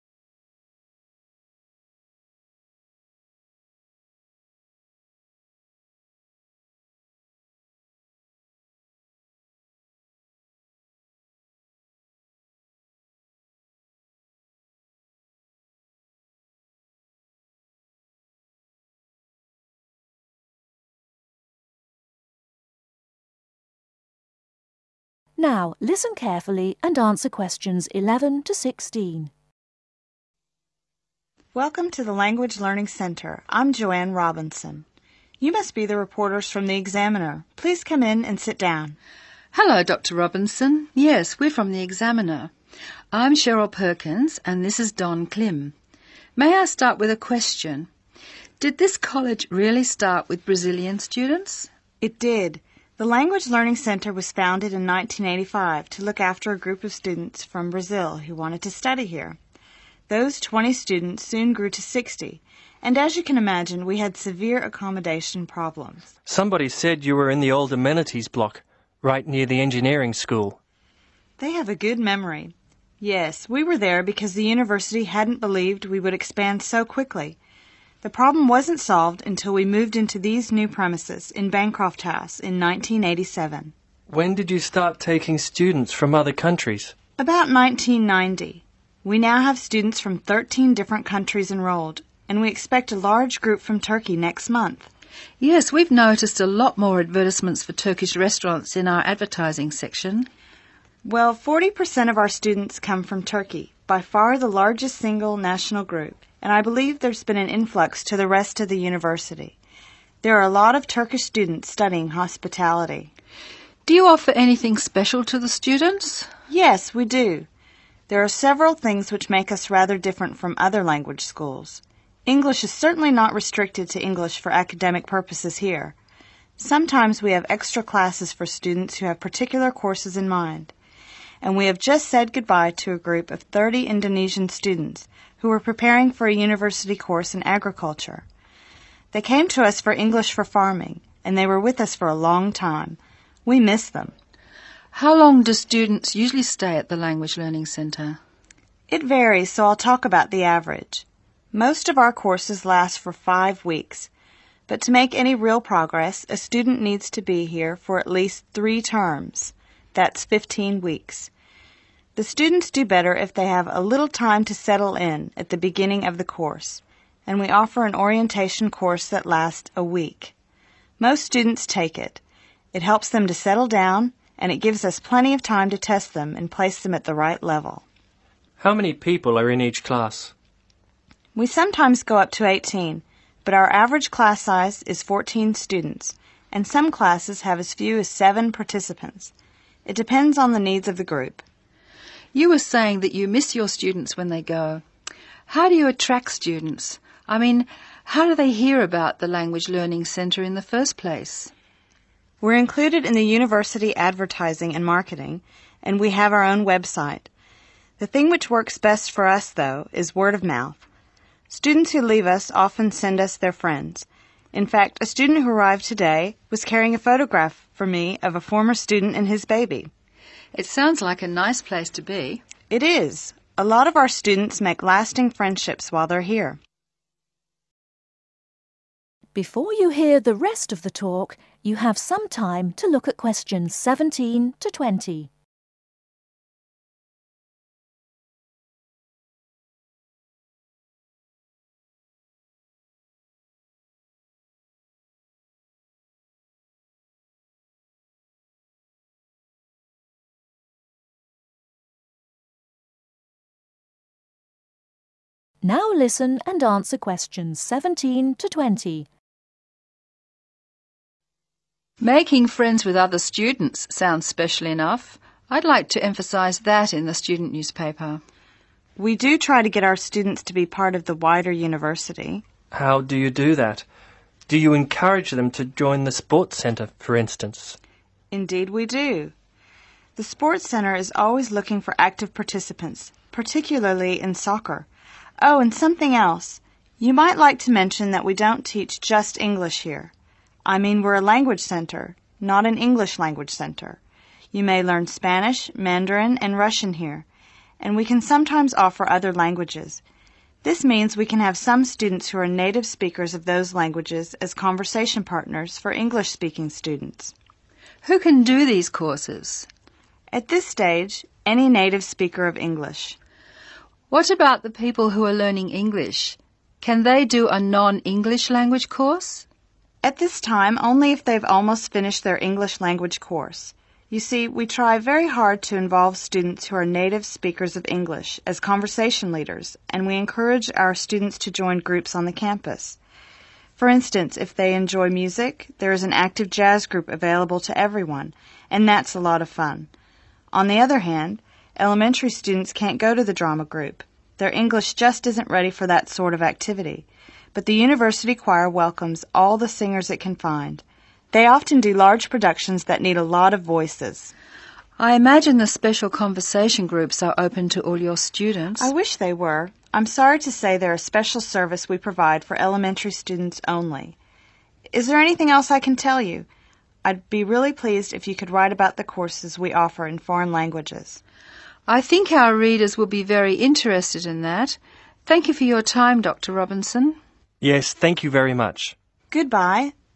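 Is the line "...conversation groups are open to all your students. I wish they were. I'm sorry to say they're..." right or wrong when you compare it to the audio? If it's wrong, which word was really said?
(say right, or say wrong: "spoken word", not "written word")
right.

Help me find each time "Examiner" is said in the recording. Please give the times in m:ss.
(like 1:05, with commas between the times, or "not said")
0:36, 0:41.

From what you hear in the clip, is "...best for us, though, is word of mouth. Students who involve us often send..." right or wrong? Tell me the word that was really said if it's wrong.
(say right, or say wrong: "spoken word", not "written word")
wrong: "leave", not "involve".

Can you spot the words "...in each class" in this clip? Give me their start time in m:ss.
2:59.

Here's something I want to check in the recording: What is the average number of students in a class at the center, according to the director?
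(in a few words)
14.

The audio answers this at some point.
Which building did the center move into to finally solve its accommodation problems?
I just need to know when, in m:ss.
1:21.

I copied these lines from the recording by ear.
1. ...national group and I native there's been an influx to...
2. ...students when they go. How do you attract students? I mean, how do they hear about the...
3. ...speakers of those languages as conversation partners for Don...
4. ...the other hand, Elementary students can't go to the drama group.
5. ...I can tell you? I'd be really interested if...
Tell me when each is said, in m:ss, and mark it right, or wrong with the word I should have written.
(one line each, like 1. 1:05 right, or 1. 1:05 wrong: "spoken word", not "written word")
1. 1:45 wrong: "believe", not "native"
2. 3:13 right
3. 5:02 wrong: "English", not "Don"
4. 5:40 right
5. 6:05 wrong: "pleased", not "interested".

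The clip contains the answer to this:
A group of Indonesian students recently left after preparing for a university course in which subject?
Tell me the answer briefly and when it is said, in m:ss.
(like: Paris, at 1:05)
agriculture, at 2:17.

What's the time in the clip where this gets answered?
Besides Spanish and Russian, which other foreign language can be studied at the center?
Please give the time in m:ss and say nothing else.
4:55.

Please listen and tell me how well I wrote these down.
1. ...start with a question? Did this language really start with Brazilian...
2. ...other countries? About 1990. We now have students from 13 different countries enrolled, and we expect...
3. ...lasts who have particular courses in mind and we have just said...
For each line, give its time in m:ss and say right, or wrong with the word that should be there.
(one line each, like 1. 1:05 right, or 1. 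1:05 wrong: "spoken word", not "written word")
1. 0:46 wrong: "college", not "language"
2. 1:26 right
3. 2:08 wrong: "students", not "lasts".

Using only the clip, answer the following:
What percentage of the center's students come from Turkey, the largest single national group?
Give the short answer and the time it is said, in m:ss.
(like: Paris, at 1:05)
40%, at 1:41.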